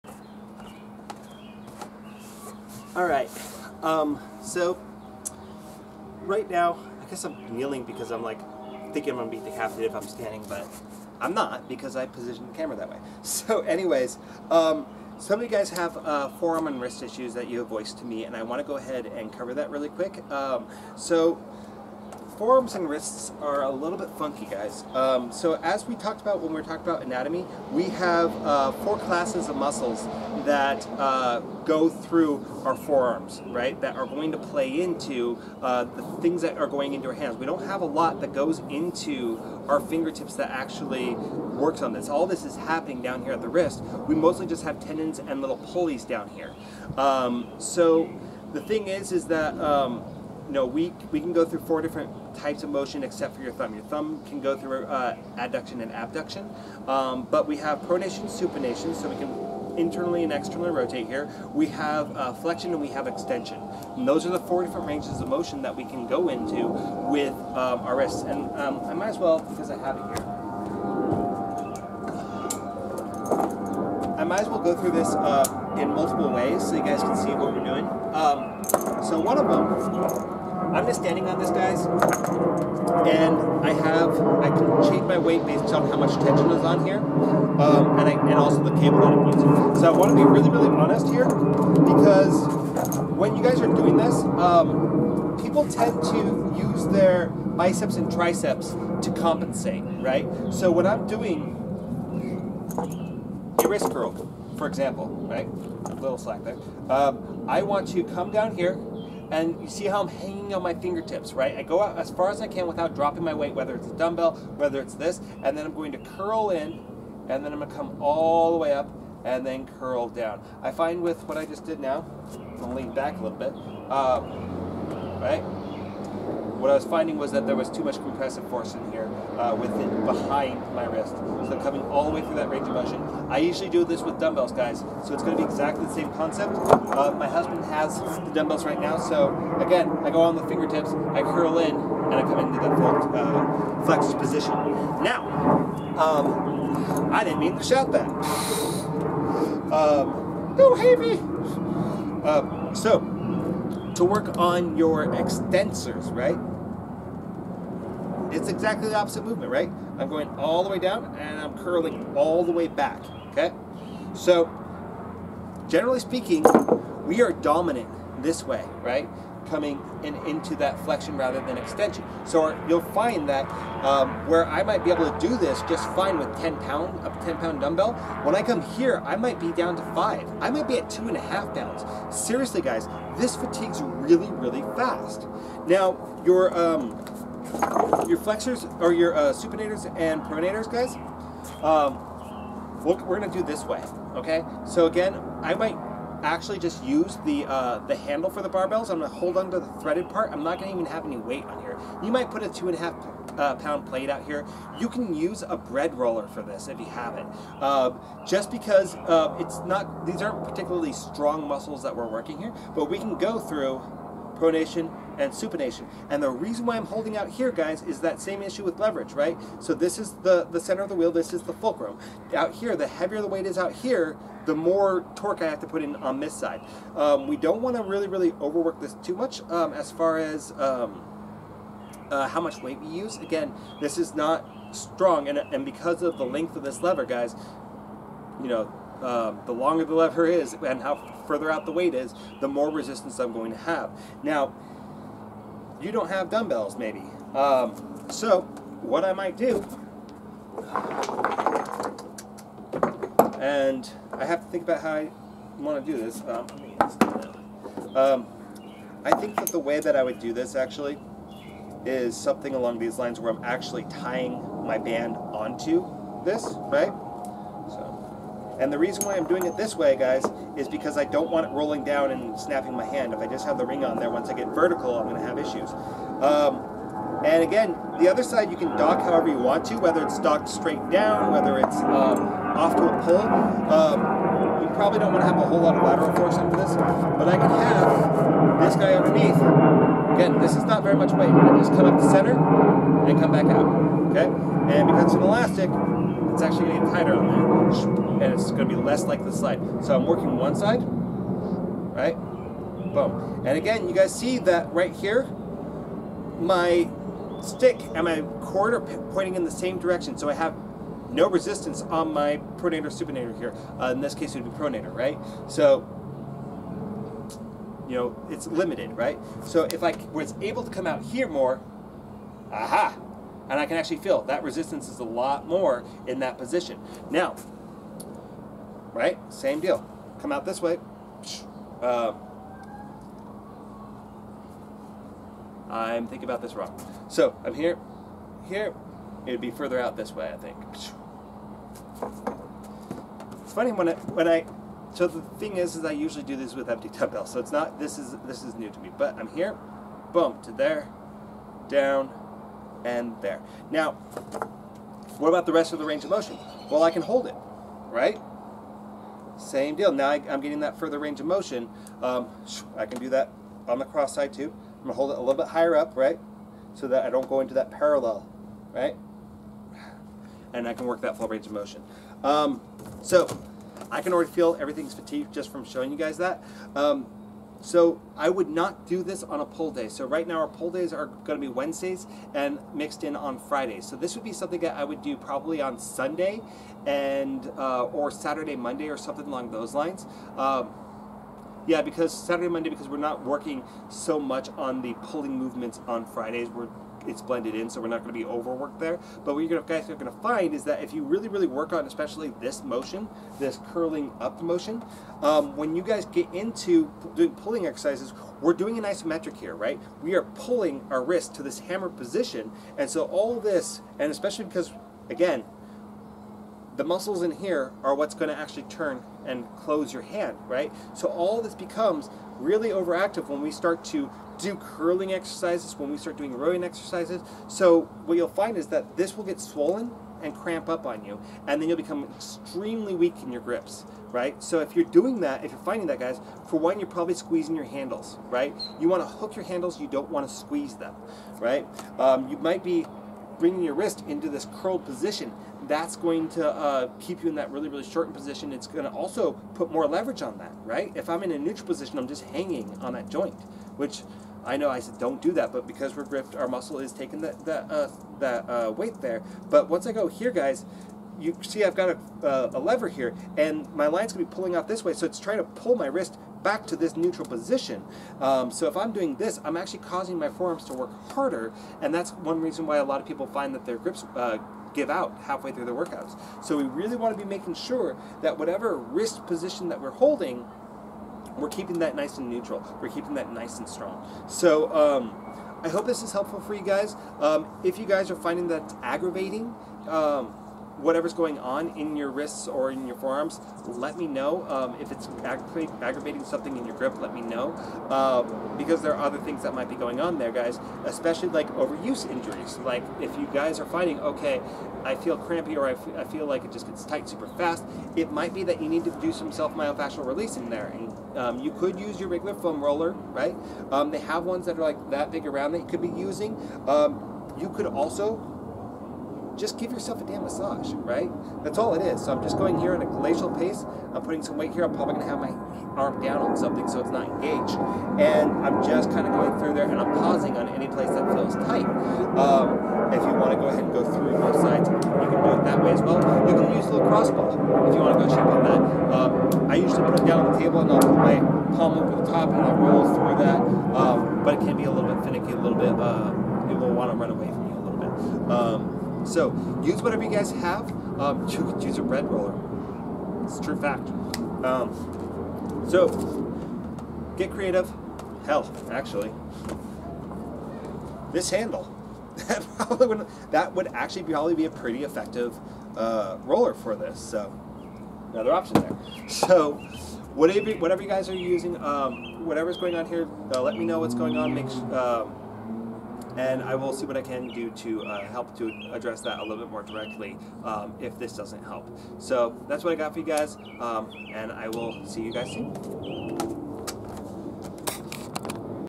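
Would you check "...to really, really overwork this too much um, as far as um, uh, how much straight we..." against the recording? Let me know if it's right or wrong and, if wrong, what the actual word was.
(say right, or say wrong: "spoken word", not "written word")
wrong: "weight", not "straight".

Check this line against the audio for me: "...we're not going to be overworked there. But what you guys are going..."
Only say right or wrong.
right.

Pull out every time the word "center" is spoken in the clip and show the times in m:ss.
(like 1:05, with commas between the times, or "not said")
3:40, 4:52.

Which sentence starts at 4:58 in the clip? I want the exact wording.
And it's going to be less like the slide.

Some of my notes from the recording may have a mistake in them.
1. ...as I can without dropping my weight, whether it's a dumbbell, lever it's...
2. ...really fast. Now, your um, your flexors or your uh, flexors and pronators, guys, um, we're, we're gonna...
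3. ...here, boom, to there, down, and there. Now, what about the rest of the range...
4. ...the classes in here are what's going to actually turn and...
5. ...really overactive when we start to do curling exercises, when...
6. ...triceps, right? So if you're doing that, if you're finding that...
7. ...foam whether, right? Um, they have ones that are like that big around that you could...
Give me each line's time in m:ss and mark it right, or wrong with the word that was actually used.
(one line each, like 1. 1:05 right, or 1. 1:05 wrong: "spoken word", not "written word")
1. 1:52 wrong: "whether", not "lever"
2. 3:04 wrong: "supinators", not "flexors"
3. 5:49 right
4. 6:56 wrong: "muscles", not "classes"
5. 7:02 right
6. 7:13 wrong: "grips", not "triceps"
7. 8:32 wrong: "roller", not "whether".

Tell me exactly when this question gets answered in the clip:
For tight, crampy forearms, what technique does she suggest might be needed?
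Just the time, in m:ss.
8:29.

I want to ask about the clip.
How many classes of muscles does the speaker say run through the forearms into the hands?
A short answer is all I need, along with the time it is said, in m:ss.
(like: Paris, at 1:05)
4, at 0:28.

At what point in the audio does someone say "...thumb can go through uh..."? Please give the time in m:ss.
0:53.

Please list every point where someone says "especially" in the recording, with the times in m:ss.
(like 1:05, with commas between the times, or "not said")
6:41, 6:54, 8:20.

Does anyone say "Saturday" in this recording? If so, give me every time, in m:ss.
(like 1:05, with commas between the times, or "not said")
6:28, 6:32.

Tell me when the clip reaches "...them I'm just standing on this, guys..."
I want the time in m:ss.
1:19.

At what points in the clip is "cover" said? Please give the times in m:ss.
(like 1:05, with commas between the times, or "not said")
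0:19.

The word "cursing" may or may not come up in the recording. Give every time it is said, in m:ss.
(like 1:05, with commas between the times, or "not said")
not said.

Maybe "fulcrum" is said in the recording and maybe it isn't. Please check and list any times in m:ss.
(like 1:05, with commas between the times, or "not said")
3:41.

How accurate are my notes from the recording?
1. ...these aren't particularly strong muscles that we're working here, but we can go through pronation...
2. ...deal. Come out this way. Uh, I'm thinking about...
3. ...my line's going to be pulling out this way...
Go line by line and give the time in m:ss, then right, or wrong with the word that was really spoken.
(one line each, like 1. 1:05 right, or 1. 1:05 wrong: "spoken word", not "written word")
1. 3:30 right
2. 5:29 right
3. 7:43 right.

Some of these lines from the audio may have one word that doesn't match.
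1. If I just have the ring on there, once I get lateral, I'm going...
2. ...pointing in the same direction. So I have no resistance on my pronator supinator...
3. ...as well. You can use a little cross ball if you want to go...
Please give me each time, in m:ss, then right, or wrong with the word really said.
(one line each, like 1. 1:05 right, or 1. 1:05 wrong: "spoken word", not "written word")
1. 4:33 wrong: "vertical", not "lateral"
2. 5:09 right
3. 8:55 right.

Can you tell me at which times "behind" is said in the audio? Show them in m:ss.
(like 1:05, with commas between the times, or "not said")
2:10.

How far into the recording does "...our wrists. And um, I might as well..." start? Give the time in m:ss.
1:07.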